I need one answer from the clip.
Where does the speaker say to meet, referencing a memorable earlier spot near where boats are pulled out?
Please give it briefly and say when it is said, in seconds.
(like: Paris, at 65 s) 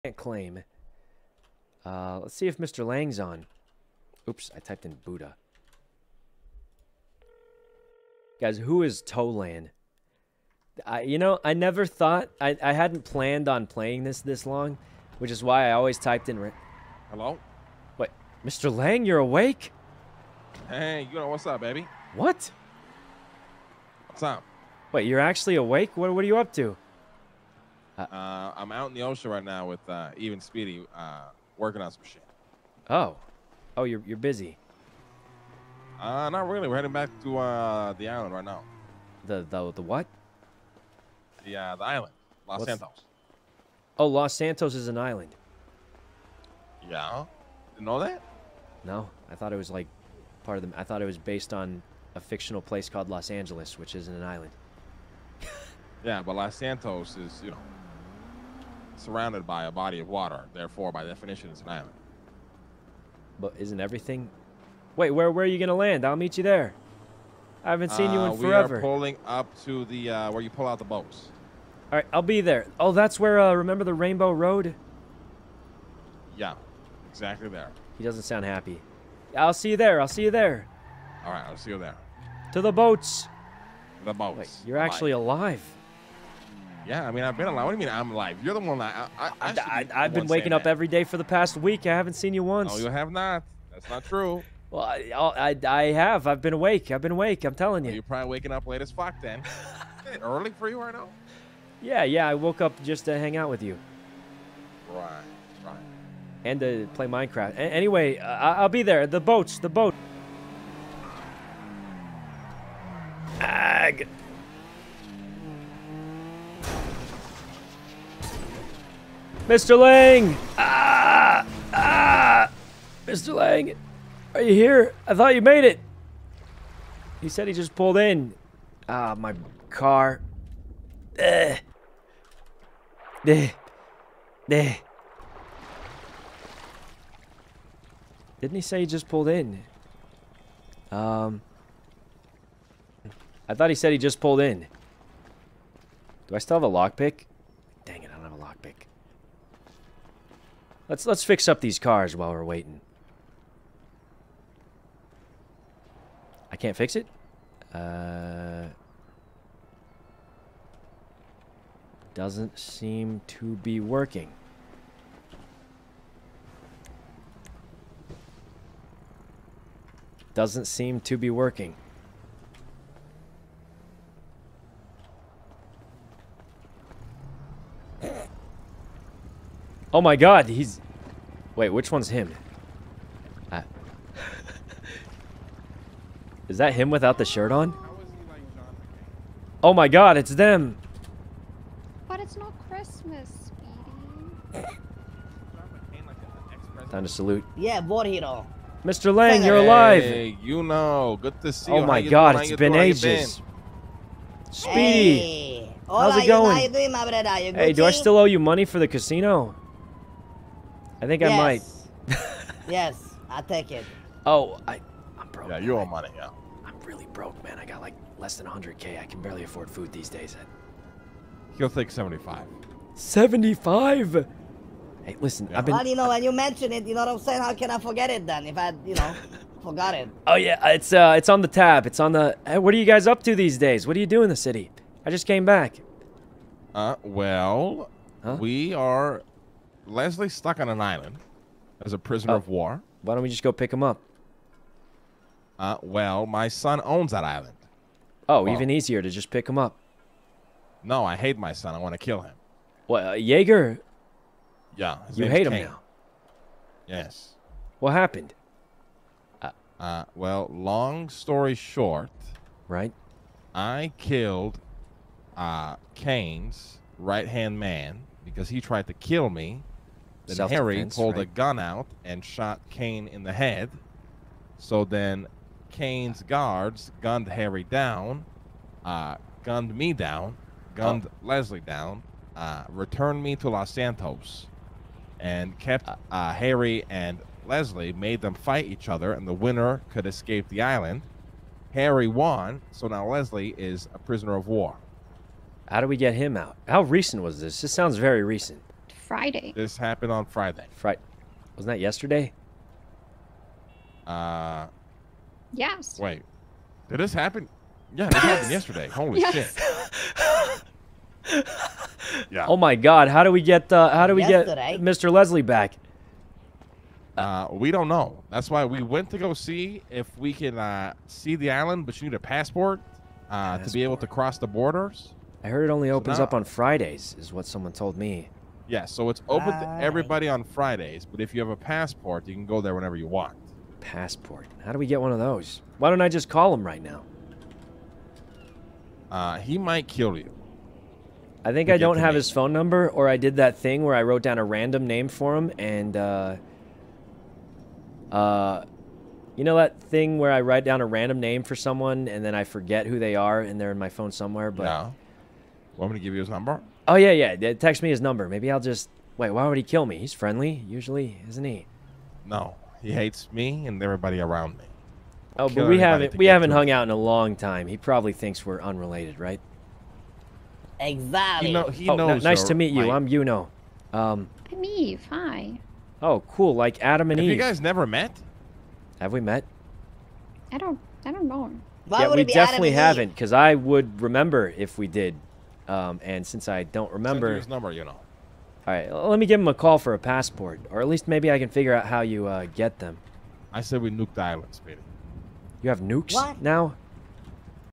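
Rainbow Road, at 73 s.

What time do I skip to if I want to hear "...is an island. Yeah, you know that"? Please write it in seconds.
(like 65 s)
44 s.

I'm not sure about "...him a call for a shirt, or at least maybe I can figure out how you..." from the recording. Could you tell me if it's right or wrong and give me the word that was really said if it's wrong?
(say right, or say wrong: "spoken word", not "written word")
wrong: "passport", not "shirt".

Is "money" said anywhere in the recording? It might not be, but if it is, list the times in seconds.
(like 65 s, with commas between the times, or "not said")
208 s, 215 s.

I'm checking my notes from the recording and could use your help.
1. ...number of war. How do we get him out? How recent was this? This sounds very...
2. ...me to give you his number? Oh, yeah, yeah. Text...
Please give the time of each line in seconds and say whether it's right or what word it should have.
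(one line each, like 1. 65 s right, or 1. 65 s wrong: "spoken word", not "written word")
1. 293 s wrong: "prisoner", not "number"
2. 355 s right.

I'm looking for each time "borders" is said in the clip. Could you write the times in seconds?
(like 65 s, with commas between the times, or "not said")
324 s.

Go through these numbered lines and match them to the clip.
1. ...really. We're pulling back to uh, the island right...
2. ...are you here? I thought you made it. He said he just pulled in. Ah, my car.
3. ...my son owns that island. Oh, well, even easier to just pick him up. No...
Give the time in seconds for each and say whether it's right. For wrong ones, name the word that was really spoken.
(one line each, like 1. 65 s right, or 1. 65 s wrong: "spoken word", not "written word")
1. 36 s wrong: "heading", not "pulling"
2. 124 s right
3. 246 s right.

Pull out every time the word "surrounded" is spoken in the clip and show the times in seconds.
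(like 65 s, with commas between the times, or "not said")
59 s.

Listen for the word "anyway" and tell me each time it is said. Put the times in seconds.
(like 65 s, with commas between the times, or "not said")
107 s.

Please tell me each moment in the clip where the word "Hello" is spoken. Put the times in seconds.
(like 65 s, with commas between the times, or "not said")
17 s.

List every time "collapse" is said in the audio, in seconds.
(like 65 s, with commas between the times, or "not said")
not said.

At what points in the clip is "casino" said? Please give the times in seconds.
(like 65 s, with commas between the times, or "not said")
208 s.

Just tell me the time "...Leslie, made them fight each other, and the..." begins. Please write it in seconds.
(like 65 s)
287 s.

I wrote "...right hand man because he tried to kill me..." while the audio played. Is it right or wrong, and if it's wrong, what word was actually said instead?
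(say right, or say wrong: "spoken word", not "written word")
right.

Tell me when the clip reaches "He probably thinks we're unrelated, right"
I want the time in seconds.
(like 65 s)
367 s.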